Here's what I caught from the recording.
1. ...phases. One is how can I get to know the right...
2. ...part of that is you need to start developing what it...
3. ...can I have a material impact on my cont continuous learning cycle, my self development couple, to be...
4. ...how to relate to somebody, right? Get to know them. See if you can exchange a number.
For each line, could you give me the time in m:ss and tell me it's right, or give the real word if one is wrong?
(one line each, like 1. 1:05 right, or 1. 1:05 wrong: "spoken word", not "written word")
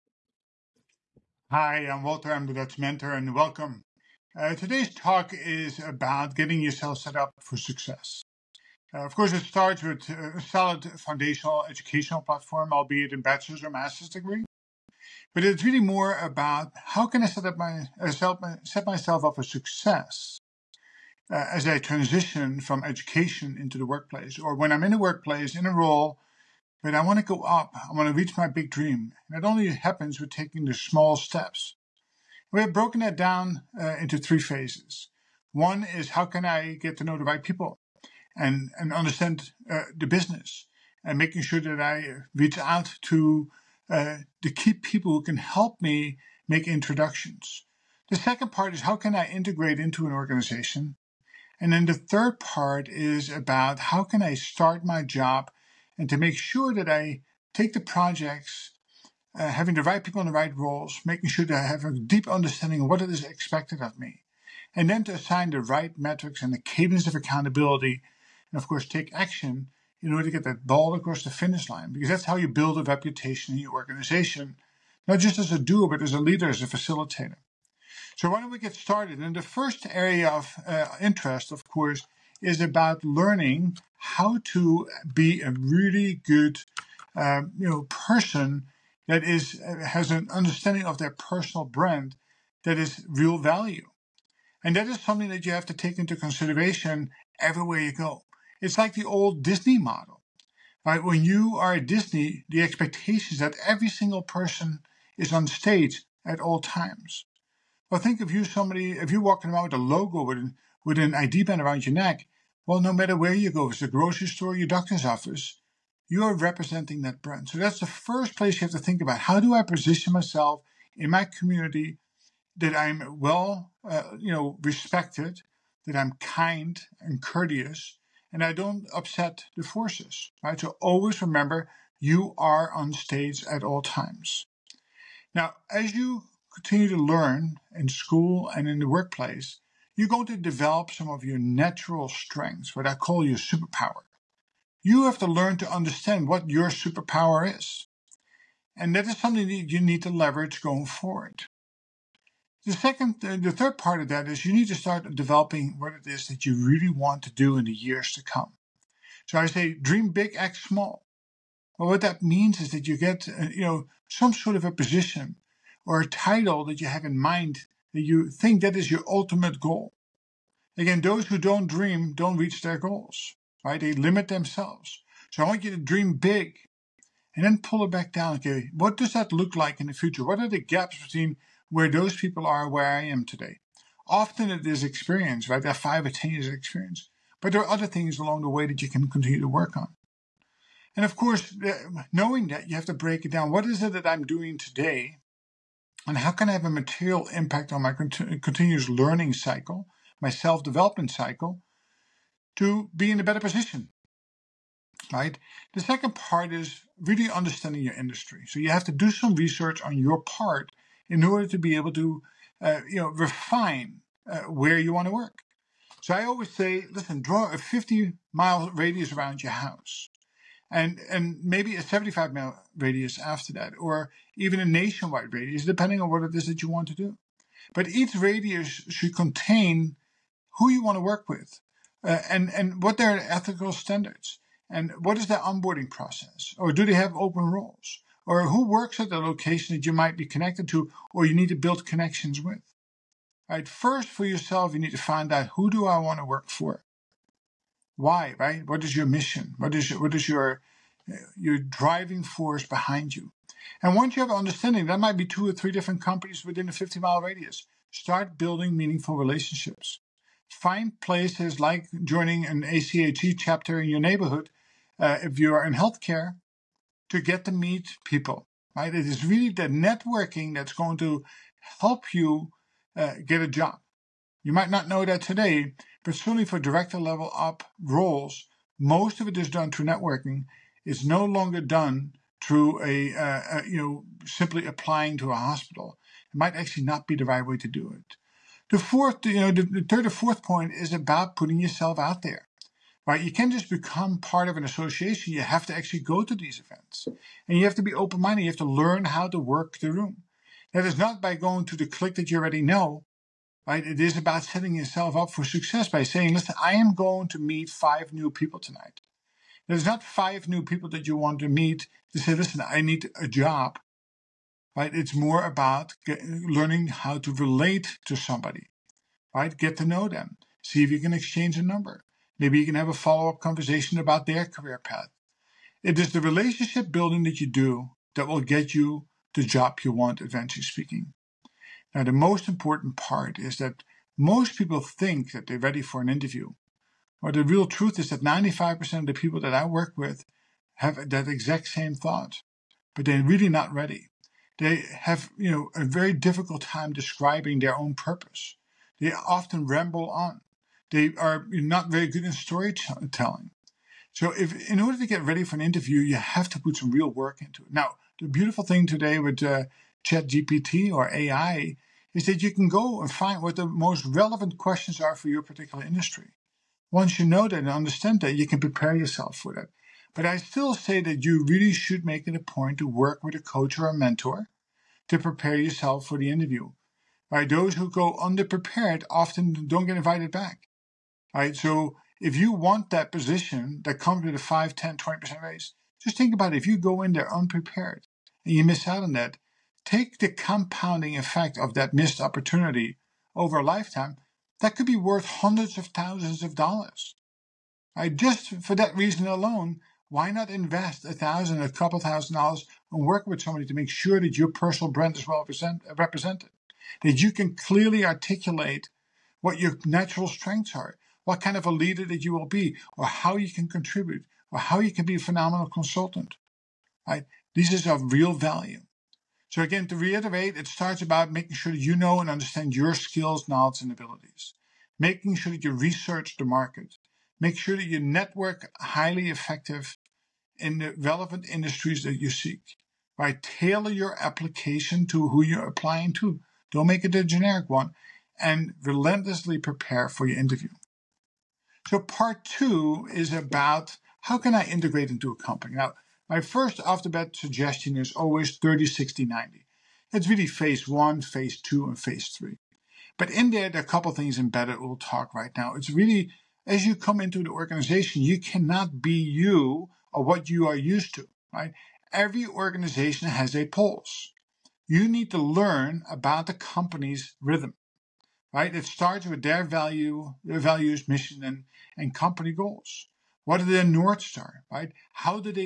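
1. 0:34 right
2. 2:33 right
3. 3:16 wrong: "cycle", not "couple"
4. 5:16 right.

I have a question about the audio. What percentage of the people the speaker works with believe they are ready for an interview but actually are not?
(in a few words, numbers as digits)
95%.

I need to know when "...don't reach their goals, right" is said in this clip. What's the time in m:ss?
2:52.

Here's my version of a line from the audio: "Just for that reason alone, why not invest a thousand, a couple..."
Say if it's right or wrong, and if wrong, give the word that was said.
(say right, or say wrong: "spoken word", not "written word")
right.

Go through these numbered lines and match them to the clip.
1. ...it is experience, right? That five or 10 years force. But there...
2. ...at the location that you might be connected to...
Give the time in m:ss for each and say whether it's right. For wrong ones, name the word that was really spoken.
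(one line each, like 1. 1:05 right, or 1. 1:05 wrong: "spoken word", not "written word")
1. 3:04 wrong: "experience", not "force"
2. 3:58 right.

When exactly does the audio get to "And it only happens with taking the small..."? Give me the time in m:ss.
0:29.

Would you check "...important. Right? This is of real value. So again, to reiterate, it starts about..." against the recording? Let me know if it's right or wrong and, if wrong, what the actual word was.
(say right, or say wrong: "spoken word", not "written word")
wrong: "consultant", not "important".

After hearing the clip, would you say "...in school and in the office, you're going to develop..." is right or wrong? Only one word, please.
wrong.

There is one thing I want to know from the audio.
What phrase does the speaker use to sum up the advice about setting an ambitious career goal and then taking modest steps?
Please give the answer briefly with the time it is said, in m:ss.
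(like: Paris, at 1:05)
Dream big, act small, at 2:39.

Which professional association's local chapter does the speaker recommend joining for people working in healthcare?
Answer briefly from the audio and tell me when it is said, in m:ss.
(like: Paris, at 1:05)
ACHE, at 4:22.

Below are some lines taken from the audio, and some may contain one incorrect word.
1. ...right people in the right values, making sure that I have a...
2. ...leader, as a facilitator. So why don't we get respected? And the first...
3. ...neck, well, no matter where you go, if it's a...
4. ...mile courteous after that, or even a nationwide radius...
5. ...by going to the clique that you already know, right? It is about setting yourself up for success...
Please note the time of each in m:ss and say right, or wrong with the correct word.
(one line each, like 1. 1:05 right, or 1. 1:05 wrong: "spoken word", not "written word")
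1. 0:59 wrong: "roles", not "values"
2. 1:16 wrong: "started", not "respected"
3. 1:51 right
4. 3:42 wrong: "radius", not "courteous"
5. 5:01 right.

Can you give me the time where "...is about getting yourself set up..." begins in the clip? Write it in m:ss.
0:05.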